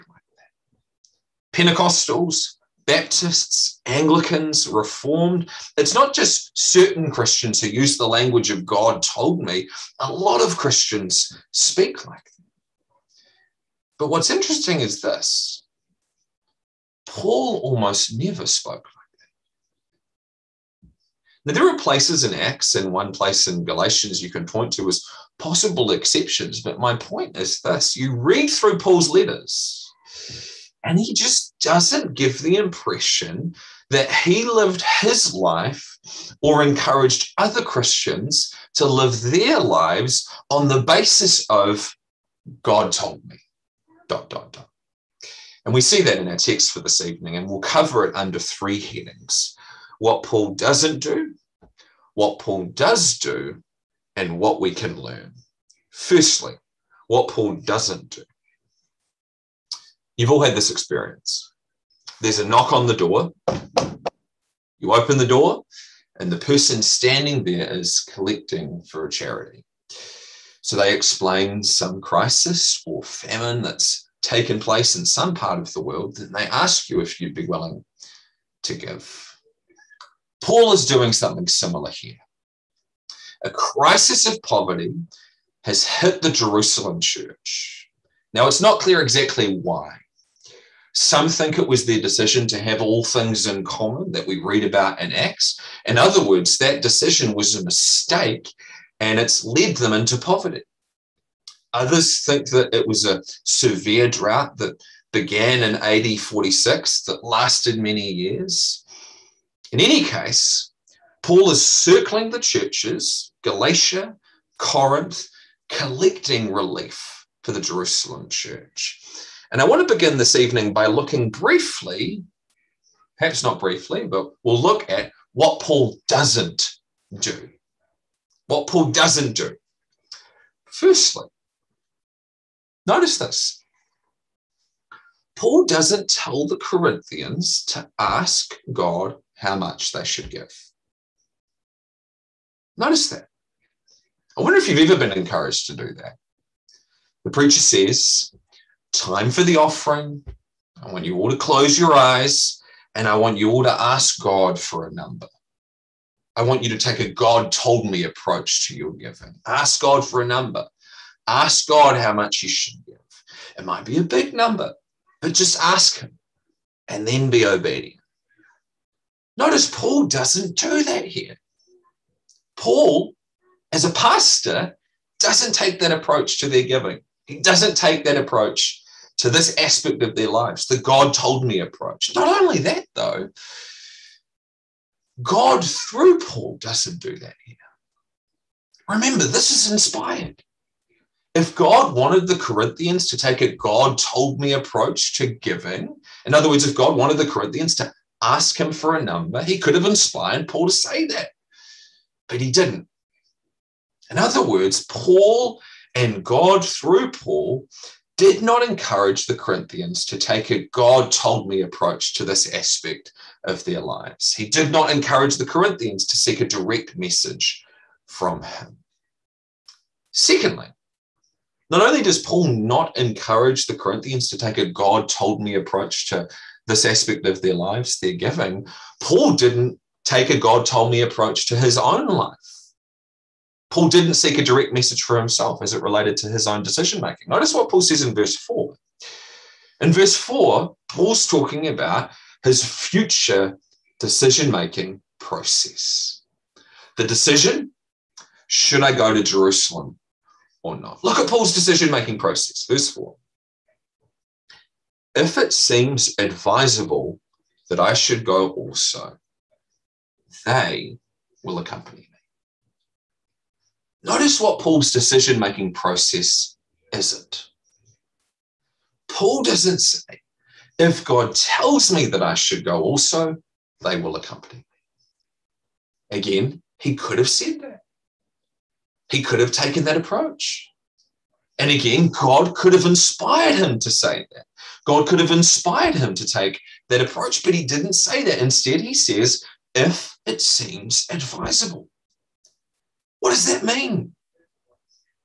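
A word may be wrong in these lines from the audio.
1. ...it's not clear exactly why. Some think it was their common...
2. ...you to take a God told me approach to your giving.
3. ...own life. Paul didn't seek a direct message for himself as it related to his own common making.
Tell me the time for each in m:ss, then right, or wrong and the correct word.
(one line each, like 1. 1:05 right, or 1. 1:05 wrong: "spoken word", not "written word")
1. 1:28 wrong: "decision", not "common"
2. 2:36 right
3. 3:51 wrong: "decision", not "common".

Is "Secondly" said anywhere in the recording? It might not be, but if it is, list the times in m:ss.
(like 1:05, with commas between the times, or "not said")
3:40.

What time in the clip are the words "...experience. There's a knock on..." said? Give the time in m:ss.
1:00.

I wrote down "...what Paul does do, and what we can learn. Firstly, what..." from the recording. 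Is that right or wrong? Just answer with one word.
right.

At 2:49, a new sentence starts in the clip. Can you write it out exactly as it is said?
Notice Paul doesn't do that here.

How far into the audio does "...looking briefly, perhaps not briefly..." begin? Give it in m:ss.
2:00.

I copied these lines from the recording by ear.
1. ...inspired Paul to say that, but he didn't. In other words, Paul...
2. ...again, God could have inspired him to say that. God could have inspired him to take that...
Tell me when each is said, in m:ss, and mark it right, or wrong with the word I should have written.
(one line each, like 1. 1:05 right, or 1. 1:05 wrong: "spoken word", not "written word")
1. 3:19 right
2. 4:41 right.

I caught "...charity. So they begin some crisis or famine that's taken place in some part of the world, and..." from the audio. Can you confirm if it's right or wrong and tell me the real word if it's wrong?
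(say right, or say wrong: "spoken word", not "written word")
wrong: "explain", not "begin".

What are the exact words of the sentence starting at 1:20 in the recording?
Paul is doing something similar here.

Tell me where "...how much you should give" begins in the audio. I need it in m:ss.
2:41.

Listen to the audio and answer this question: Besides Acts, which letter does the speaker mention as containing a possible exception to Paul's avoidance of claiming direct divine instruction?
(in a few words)
Galatians.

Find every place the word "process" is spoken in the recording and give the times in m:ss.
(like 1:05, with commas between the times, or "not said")
4:05, 4:12, 4:25.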